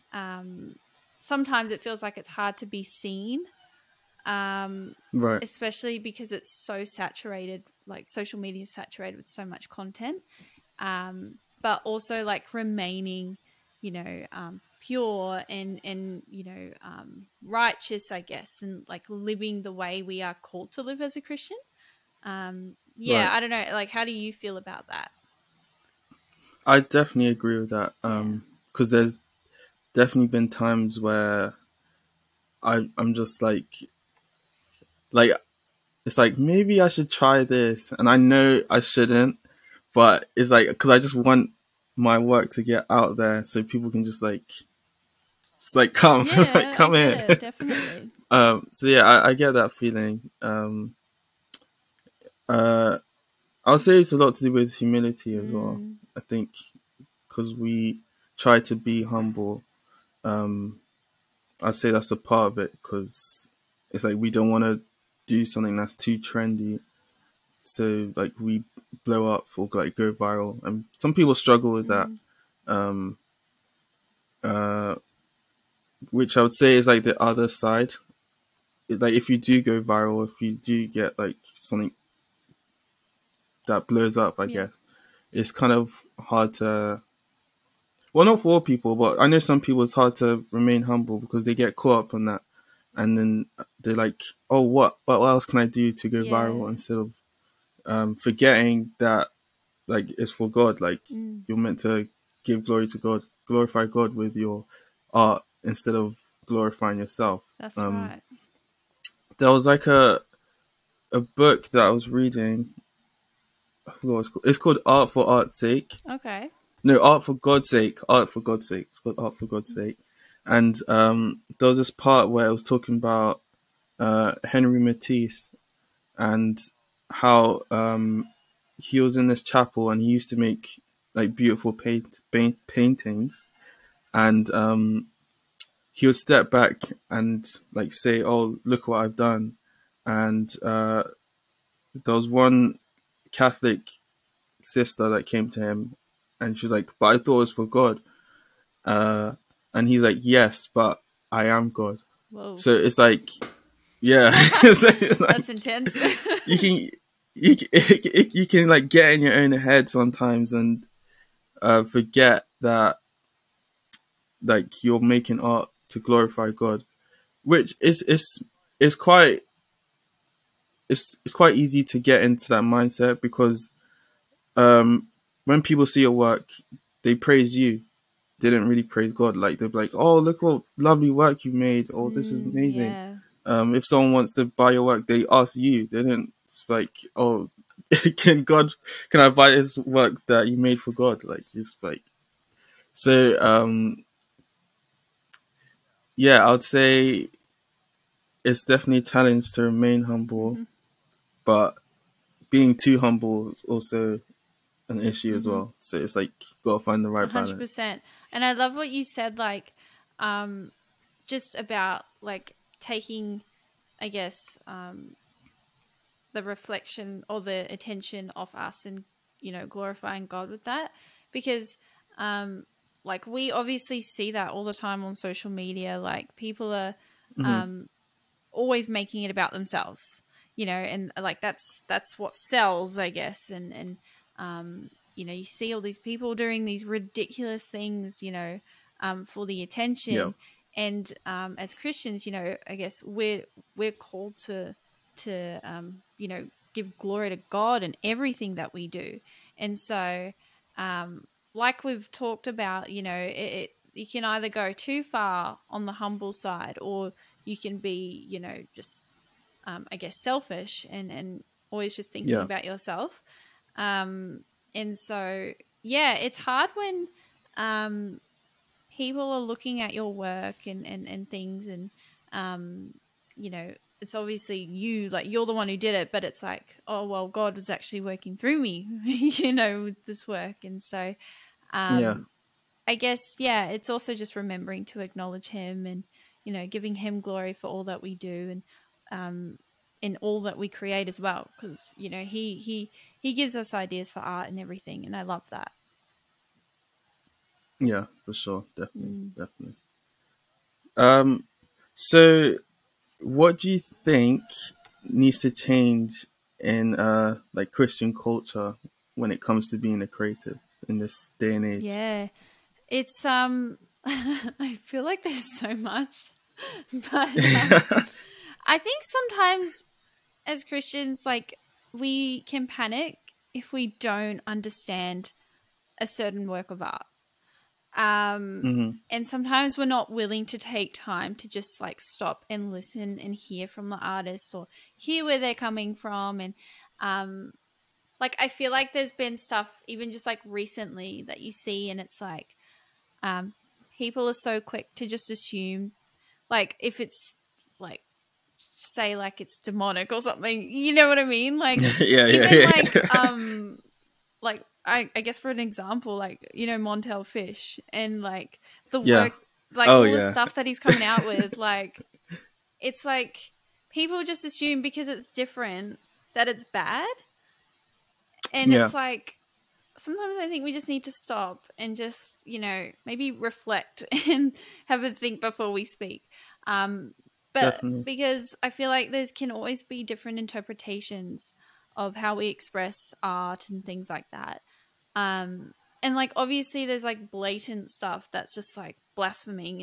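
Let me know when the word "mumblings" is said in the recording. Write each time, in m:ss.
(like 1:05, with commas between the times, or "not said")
not said.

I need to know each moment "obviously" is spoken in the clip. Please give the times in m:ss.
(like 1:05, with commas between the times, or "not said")
3:43, 4:34, 6:26.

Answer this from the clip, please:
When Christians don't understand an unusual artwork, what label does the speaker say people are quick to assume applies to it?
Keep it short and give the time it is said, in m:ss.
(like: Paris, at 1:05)
demonic, at 5:49.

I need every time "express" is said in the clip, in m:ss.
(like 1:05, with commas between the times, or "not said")
6:22.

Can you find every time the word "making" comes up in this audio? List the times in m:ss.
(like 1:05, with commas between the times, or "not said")
2:45, 3:48.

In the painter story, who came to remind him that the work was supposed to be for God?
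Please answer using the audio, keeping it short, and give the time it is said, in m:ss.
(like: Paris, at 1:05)
Catholic sister, at 2:23.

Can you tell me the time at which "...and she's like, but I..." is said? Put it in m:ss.
2:26.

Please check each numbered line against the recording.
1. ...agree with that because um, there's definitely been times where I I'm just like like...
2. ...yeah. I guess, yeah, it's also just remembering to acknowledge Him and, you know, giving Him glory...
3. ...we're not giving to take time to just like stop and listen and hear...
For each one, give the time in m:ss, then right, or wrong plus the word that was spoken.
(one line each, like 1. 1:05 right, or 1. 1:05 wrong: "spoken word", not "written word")
1. 0:27 right
2. 4:42 right
3. 5:29 wrong: "willing", not "giving".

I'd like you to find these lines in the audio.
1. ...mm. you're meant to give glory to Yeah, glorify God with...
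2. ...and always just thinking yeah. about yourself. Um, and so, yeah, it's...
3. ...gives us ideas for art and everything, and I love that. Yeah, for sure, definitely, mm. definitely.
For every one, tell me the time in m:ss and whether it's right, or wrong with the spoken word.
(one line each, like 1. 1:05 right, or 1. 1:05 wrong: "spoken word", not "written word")
1. 1:41 wrong: "God", not "Yeah"
2. 4:21 right
3. 4:53 right.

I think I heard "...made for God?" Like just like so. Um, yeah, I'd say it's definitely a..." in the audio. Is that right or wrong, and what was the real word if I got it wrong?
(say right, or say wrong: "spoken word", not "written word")
right.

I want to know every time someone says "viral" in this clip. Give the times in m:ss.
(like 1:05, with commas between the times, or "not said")
1:10, 1:19, 1:36.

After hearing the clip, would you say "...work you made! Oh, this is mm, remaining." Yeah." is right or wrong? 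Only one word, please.
wrong.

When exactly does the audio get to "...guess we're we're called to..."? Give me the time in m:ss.
4:02.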